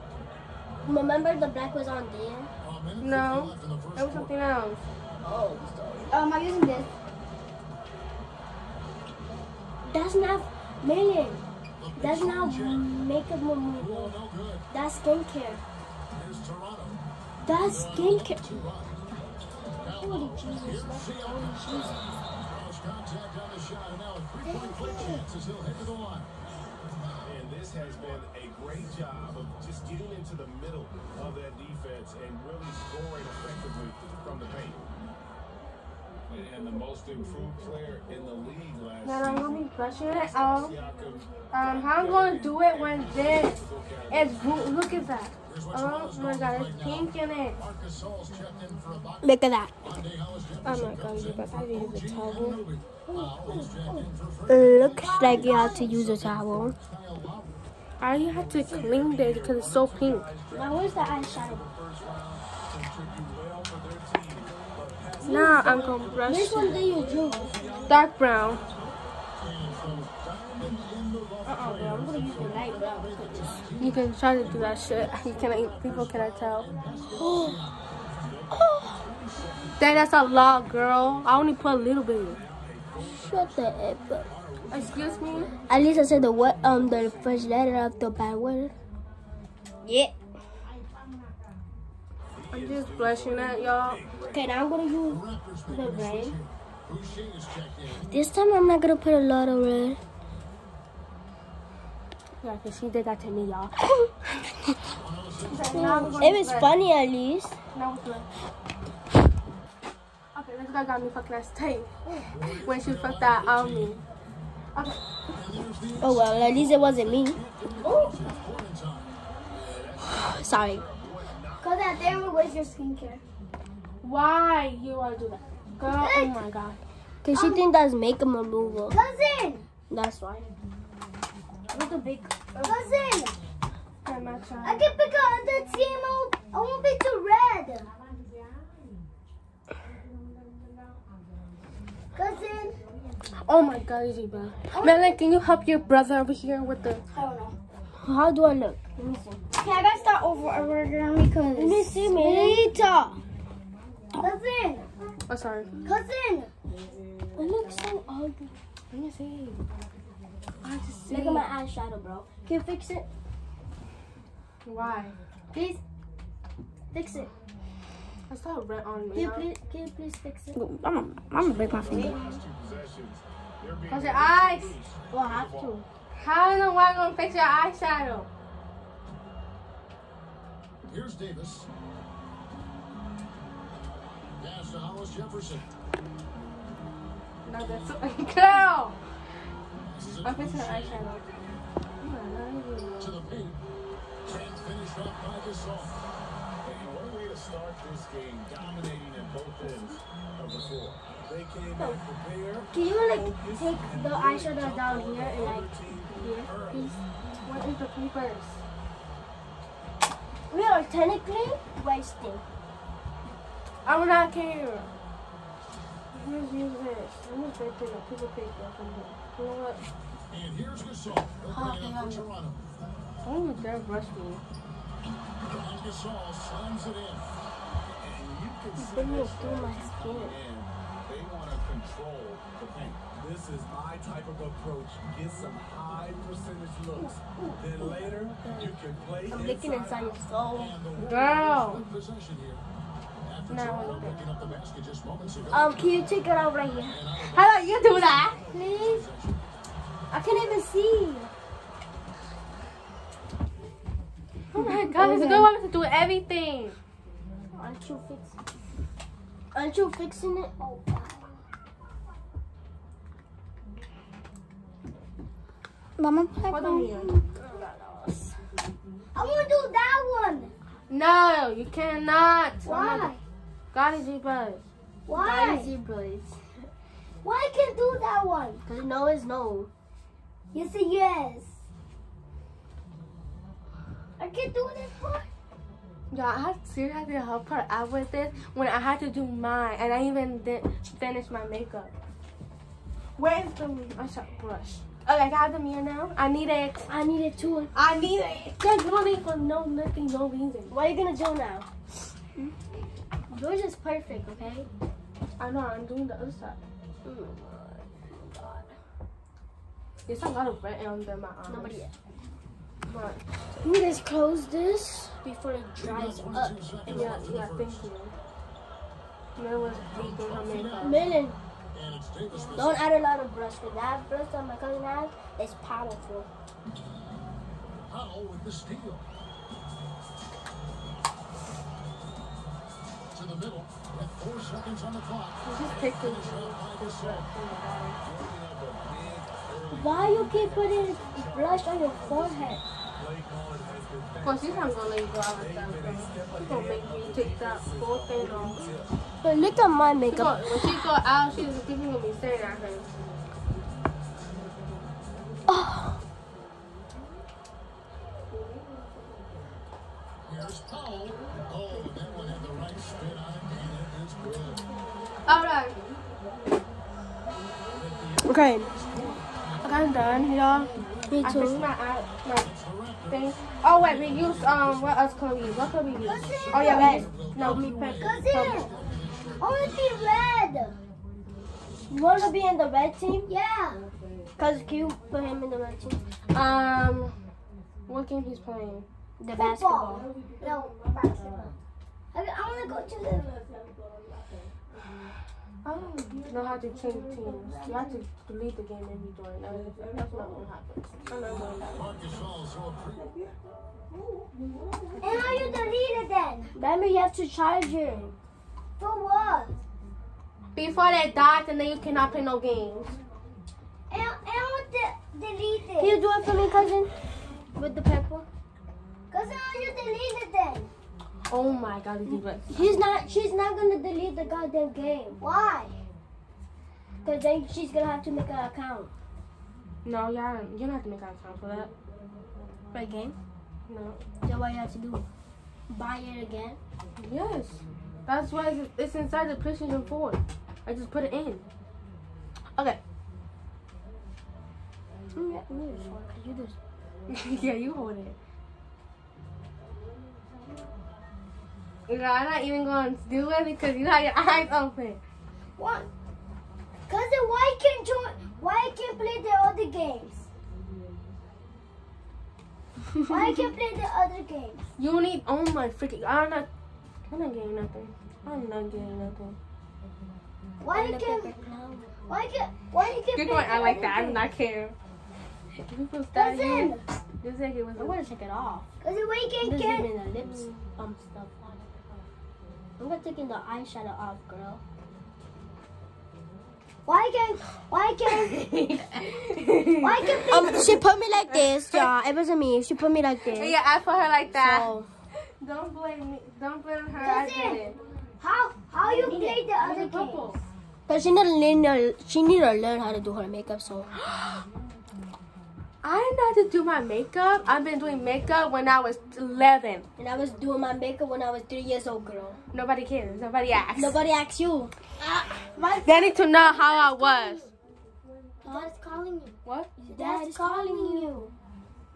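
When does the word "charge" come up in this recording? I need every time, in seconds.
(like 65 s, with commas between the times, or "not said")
407 s.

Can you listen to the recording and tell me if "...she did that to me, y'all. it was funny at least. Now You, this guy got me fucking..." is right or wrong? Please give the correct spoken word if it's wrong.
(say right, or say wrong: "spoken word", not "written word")
wrong: "Okay", not "You".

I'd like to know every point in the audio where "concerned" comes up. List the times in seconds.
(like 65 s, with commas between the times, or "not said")
not said.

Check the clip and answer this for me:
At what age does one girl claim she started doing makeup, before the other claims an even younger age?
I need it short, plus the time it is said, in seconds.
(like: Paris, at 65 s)
11, at 509 s.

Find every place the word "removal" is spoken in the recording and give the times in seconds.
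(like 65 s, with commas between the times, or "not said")
13 s, 128 s.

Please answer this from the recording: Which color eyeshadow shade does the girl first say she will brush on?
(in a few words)
Dark brown.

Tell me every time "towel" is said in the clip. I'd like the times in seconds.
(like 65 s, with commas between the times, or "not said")
52 s, 56 s.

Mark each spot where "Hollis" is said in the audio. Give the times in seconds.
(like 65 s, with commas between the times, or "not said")
184 s.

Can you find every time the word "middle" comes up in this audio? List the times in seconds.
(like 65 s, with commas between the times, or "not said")
30 s, 333 s.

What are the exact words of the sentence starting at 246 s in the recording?
How about you do that, please?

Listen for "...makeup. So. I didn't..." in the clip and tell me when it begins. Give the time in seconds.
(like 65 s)
503 s.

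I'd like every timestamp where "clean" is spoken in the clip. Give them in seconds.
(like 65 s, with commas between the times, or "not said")
58 s.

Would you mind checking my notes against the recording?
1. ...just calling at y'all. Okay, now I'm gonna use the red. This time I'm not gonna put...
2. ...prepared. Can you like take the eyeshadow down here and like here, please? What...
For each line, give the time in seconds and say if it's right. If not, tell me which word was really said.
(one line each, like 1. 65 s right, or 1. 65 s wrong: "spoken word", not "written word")
1. 92 s wrong: "blushing", not "calling"
2. 202 s right.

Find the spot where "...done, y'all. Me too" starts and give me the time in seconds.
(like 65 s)
369 s.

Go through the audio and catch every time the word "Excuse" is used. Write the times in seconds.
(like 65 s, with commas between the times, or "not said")
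84 s.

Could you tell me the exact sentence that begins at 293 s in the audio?
Where is the I saw brush?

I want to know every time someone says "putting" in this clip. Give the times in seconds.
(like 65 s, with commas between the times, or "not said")
190 s, 340 s.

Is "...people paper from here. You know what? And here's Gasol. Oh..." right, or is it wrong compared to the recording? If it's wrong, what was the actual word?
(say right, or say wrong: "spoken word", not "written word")
right.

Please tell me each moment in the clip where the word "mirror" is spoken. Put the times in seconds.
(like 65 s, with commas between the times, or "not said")
295 s.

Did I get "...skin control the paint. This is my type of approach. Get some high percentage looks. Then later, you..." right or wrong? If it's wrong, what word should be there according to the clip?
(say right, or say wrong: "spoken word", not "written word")
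right.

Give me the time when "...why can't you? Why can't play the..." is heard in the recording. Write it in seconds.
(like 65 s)
457 s.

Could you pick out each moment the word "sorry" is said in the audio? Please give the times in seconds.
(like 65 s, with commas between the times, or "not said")
120 s, 155 s.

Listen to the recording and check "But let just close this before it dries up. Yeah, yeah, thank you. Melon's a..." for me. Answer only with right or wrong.
right.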